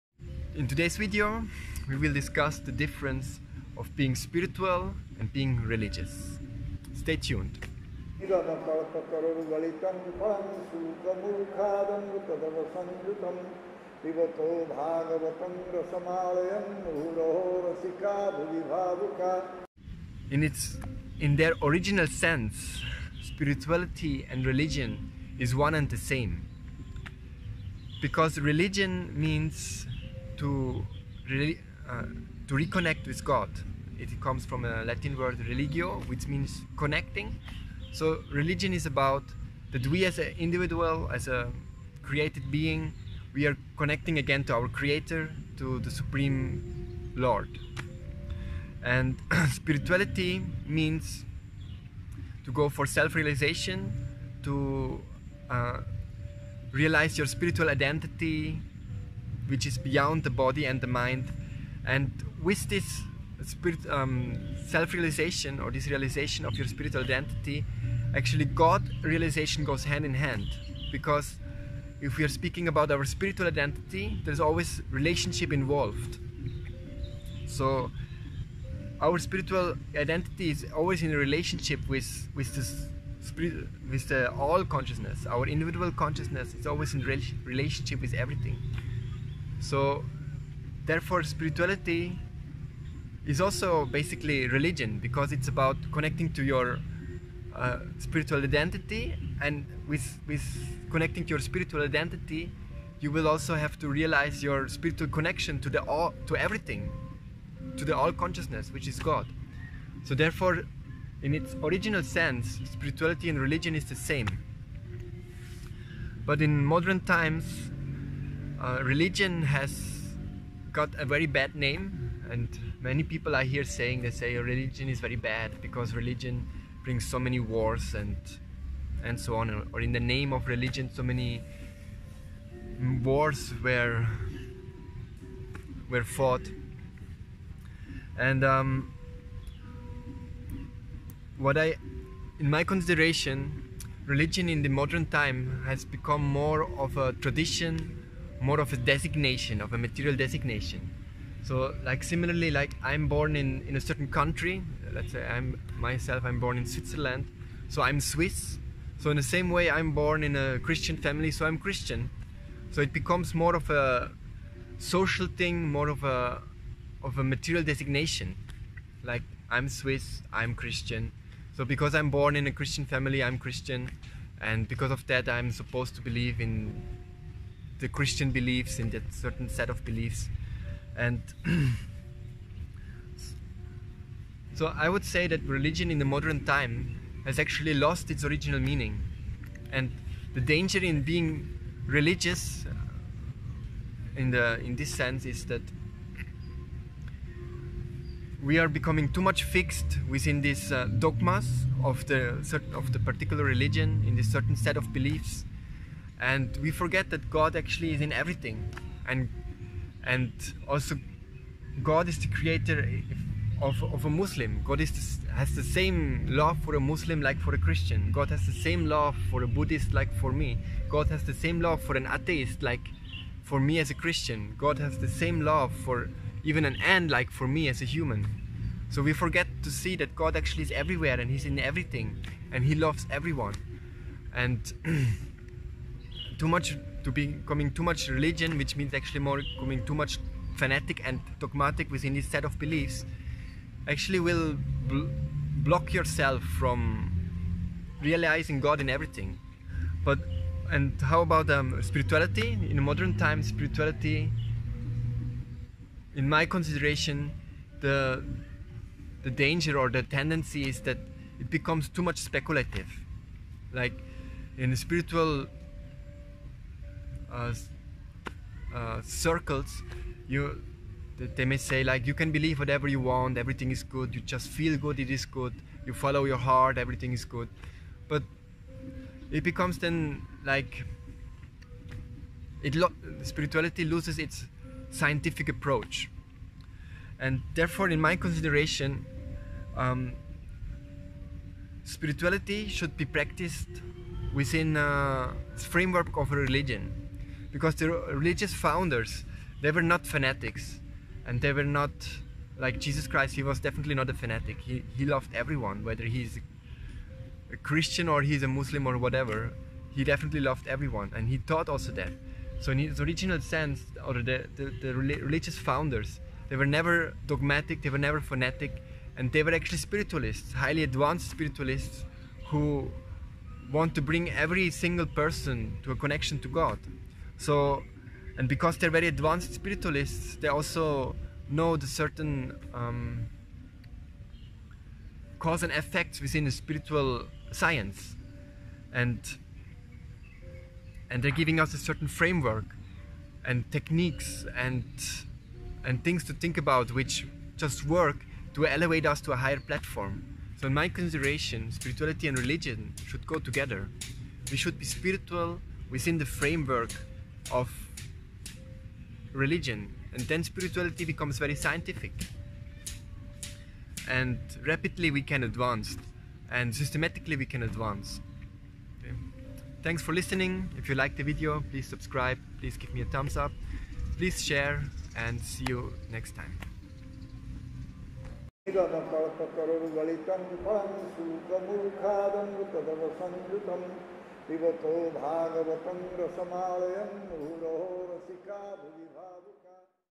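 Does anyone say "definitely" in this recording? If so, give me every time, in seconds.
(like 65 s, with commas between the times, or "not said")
303 s, 310 s.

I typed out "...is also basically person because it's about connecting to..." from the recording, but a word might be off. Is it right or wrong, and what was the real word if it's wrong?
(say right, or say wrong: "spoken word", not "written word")
wrong: "religion", not "person".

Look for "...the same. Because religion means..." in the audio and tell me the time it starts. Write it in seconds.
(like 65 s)
25 s.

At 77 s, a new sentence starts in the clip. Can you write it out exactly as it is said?
So our spiritual identity is always in a relationship with with this spirit, with the all consciousness.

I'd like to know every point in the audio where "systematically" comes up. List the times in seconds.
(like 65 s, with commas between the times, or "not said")
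366 s.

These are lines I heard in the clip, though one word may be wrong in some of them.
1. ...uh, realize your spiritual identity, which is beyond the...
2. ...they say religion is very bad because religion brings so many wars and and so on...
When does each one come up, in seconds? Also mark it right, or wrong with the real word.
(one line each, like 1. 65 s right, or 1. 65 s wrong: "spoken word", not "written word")
1. 55 s right
2. 124 s right.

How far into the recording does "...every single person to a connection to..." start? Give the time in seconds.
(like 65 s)
324 s.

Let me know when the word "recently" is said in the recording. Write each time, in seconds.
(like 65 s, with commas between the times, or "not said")
not said.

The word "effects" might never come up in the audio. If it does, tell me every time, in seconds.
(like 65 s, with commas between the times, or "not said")
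335 s.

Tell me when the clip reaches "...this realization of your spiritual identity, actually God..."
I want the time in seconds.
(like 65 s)
65 s.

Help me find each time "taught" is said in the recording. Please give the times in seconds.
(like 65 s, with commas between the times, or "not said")
311 s.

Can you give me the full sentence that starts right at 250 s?
But and how about um, spirituality in modern times?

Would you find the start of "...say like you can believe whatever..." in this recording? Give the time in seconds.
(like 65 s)
271 s.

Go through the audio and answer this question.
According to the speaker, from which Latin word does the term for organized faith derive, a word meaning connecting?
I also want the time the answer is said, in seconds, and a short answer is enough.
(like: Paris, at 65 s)
religio, at 35 s.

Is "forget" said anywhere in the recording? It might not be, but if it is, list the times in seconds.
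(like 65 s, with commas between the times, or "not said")
206 s, 229 s.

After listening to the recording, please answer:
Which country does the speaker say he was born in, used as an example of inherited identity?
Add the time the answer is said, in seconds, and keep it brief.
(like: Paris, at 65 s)
Switzerland, at 156 s.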